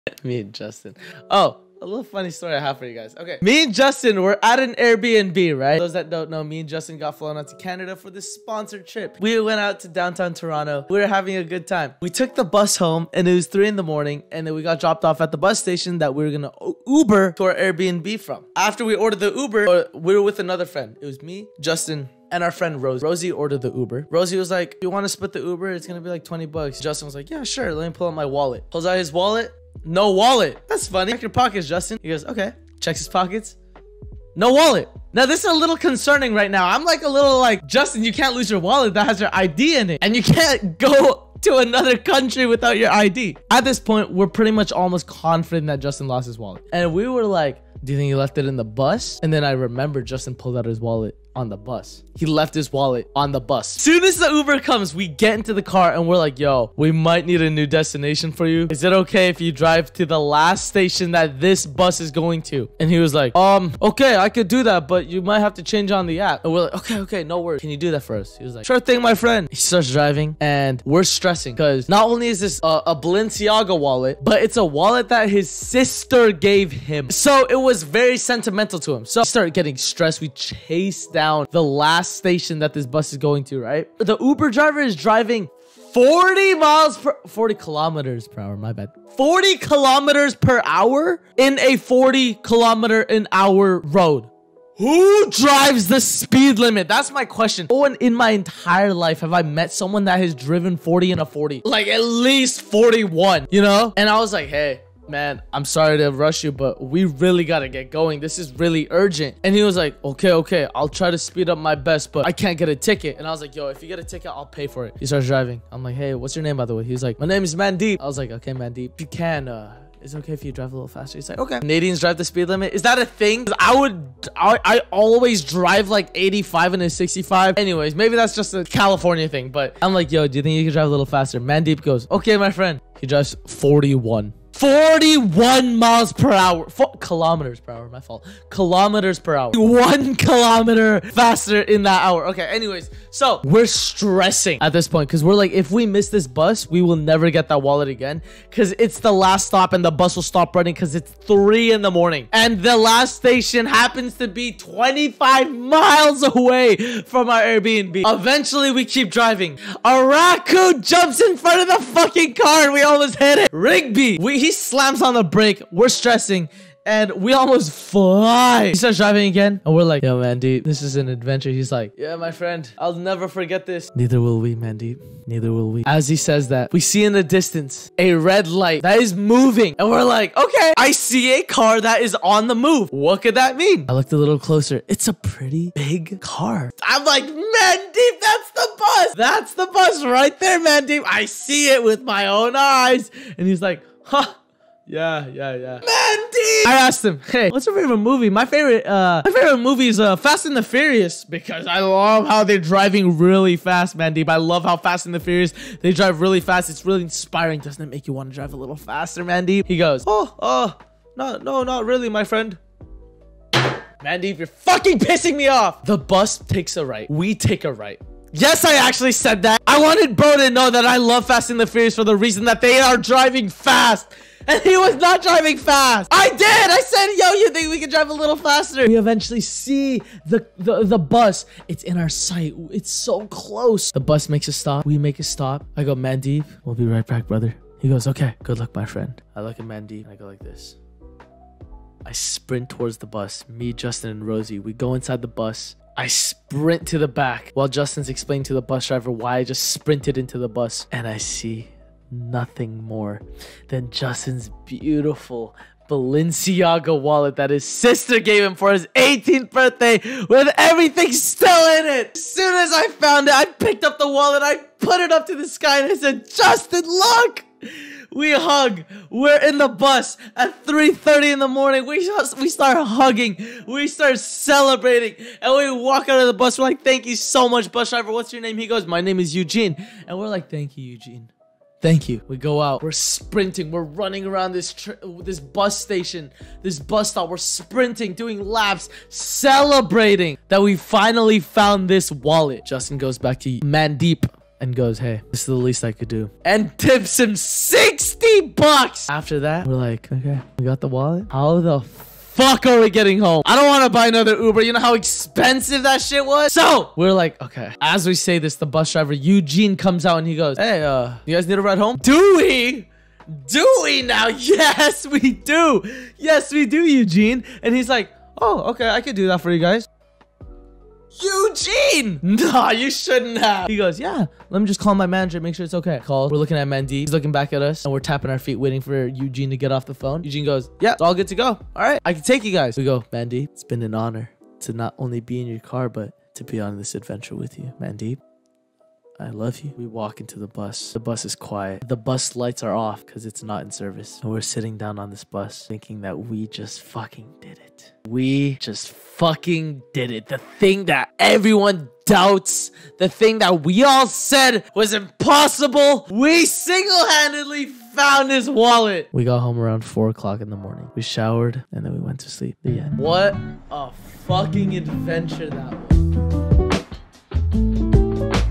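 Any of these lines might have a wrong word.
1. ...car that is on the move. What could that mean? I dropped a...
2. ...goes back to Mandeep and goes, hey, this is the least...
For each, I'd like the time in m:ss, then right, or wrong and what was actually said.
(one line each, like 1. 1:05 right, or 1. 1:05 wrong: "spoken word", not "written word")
1. 3:01 wrong: "looked", not "dropped"
2. 4:52 right.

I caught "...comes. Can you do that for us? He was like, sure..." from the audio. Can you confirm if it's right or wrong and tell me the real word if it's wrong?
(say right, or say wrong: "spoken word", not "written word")
wrong: "worries", not "comes".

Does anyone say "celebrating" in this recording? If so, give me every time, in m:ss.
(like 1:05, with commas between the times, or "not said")
4:34, 4:49.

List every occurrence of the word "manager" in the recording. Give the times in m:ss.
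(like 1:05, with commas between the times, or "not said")
5:25.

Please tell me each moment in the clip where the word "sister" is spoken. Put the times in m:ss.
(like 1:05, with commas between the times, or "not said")
1:15, 4:17.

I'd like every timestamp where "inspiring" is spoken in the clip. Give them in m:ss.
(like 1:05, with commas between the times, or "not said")
3:27.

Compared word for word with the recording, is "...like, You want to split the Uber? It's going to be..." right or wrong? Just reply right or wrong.
right.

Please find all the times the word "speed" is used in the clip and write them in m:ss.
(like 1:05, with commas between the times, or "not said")
1:36, 1:51, 2:02.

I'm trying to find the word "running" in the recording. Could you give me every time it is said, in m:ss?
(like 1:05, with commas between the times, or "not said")
2:30, 4:44.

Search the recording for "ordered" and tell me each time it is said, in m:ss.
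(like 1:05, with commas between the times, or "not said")
0:18, 0:23.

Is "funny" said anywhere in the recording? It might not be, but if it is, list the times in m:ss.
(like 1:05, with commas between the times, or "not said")
0:02, 0:30.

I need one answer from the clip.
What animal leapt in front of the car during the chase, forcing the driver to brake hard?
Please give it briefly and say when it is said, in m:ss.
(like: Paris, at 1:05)
Raccoon, at 2:40.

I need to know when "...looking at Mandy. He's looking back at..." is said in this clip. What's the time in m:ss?
5:26.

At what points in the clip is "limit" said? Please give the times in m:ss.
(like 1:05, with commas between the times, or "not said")
1:36, 2:02.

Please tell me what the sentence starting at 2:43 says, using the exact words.
Rigby, we he slams on the brake.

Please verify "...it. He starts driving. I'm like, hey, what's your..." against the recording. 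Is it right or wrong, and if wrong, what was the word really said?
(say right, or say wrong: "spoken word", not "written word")
right.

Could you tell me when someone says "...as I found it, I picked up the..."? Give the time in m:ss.
4:22.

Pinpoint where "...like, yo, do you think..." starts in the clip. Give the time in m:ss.
2:09.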